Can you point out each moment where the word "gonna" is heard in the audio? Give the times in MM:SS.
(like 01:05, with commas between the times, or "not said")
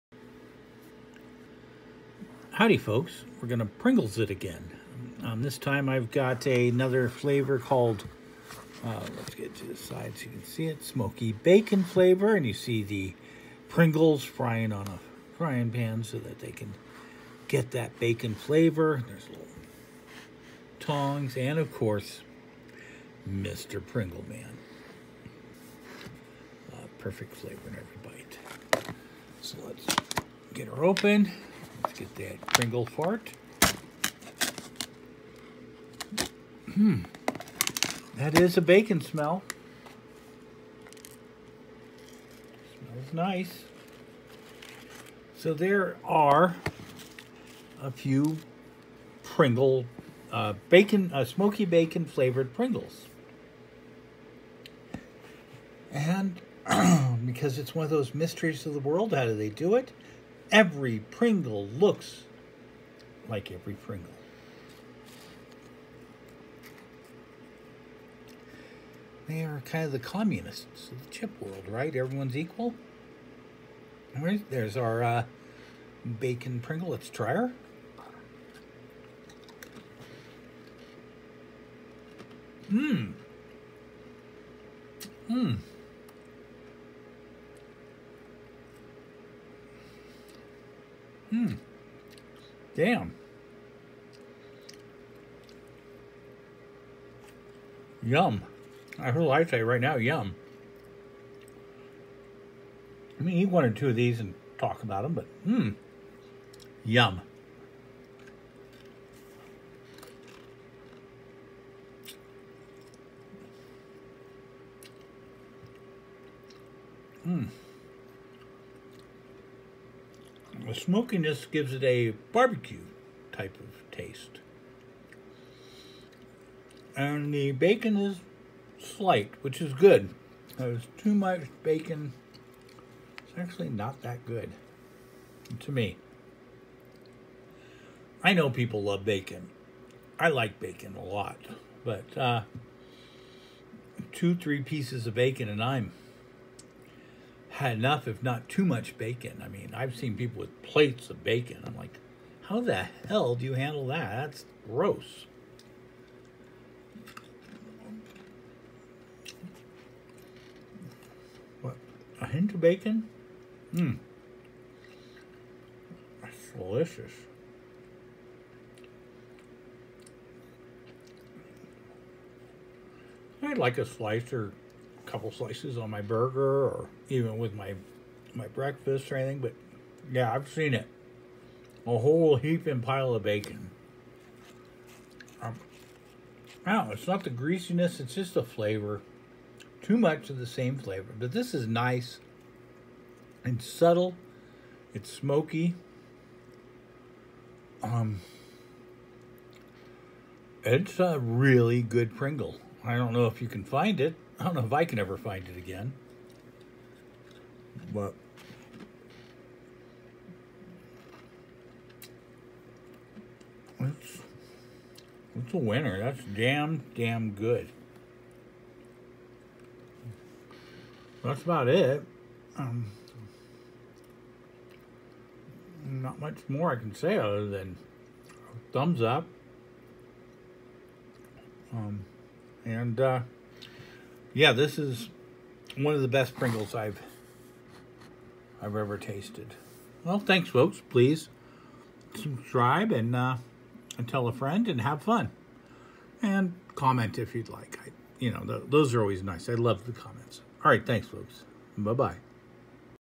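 00:03.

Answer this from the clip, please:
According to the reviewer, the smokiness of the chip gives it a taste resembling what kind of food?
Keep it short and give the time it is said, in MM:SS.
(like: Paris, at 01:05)
Barbecue, at 02:02.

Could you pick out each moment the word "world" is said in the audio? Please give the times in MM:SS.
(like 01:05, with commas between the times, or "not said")
00:58, 01:11.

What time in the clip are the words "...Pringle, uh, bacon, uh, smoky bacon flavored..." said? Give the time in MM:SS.
00:49.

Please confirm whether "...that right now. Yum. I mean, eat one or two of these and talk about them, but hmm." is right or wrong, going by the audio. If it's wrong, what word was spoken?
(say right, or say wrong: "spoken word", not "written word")
right.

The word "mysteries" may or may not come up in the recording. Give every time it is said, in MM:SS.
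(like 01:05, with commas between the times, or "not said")
00:58.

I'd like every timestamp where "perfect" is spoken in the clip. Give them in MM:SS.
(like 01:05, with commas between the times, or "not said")
00:26.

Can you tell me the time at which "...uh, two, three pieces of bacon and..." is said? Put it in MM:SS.
02:22.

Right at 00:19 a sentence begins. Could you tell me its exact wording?
There's little tongs, and of course, Mr.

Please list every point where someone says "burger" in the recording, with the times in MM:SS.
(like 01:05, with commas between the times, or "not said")
02:56.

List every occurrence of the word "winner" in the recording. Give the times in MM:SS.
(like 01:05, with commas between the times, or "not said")
03:35.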